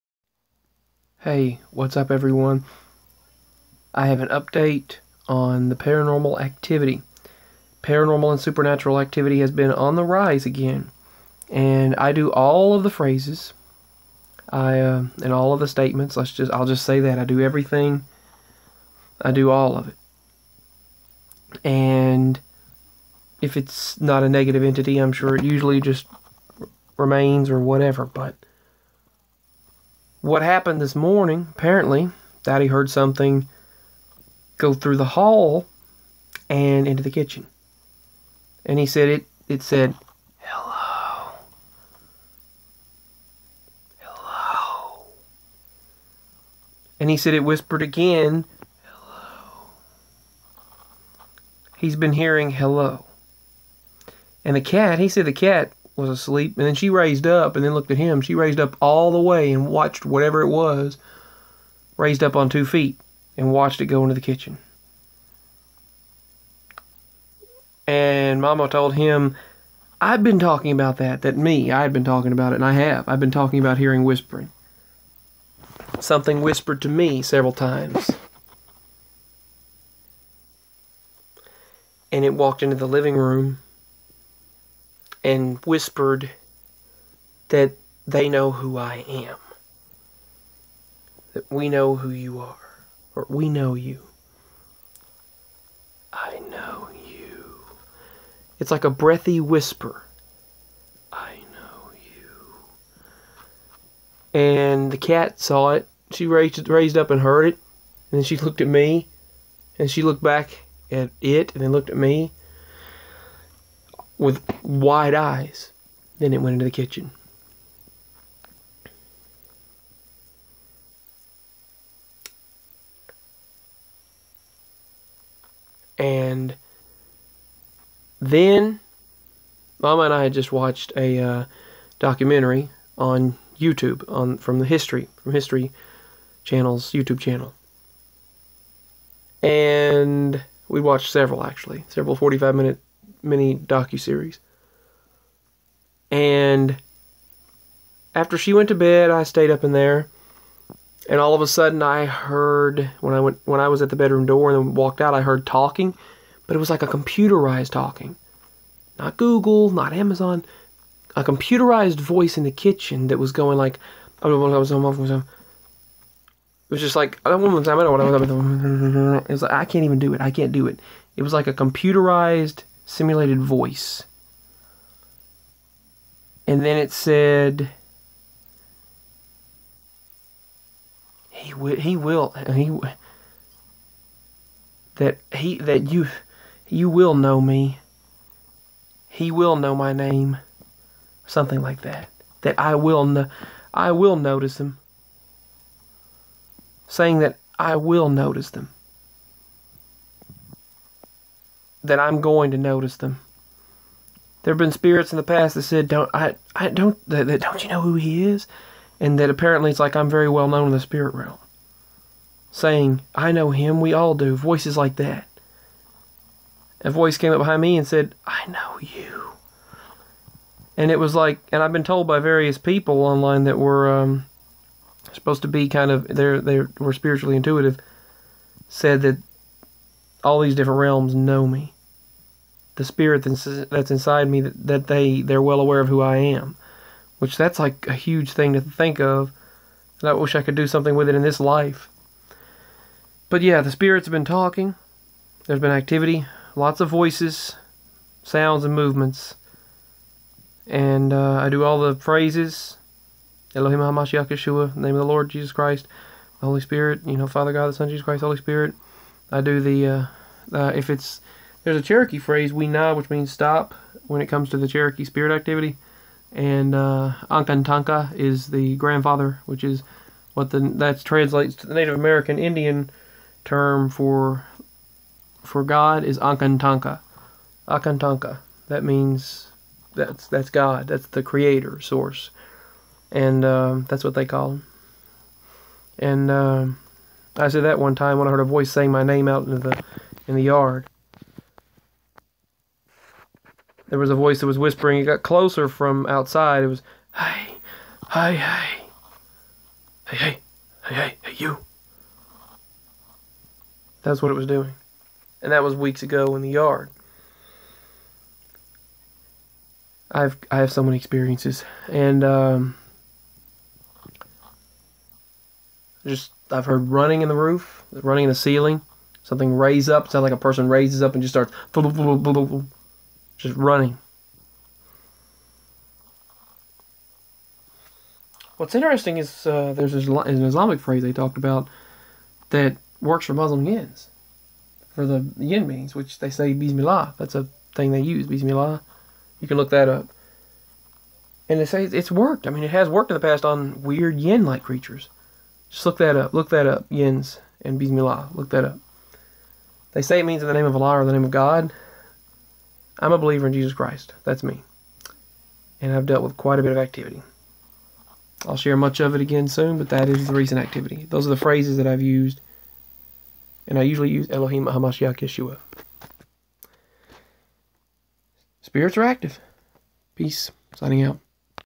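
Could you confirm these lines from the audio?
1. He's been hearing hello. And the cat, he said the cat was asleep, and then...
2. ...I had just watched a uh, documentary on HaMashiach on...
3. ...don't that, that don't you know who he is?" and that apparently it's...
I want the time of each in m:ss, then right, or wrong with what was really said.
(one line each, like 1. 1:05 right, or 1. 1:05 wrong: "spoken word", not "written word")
1. 0:51 right
2. 2:10 wrong: "YouTube", not "HaMashiach"
3. 3:26 right.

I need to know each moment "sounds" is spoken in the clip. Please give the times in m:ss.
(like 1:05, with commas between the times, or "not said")
4:08, 5:20.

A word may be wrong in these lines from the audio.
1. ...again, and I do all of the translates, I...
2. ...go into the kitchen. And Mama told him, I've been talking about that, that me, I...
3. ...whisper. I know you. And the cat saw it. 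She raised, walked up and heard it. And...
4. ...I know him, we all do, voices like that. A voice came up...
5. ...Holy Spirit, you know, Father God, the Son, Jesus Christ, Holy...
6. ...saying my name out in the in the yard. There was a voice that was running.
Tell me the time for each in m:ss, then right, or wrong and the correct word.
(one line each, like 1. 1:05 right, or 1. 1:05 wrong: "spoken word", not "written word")
1. 0:10 wrong: "phrases", not "translates"
2. 1:03 right
3. 1:39 wrong: "raised", not "walked"
4. 3:33 right
5. 4:16 right
6. 4:48 wrong: "whispering", not "running".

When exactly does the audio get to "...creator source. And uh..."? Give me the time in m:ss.
4:41.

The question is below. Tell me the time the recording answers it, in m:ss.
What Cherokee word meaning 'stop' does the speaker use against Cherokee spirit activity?
4:22.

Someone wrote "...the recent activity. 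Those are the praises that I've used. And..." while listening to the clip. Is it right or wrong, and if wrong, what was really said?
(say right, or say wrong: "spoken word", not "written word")
wrong: "phrases", not "praises".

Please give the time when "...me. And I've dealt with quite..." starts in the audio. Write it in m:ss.
5:54.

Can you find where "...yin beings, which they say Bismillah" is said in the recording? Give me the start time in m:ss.
5:35.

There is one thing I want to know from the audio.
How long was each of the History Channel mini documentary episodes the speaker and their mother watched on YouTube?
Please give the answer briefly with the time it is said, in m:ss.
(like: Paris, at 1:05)
45 minutes, at 2:22.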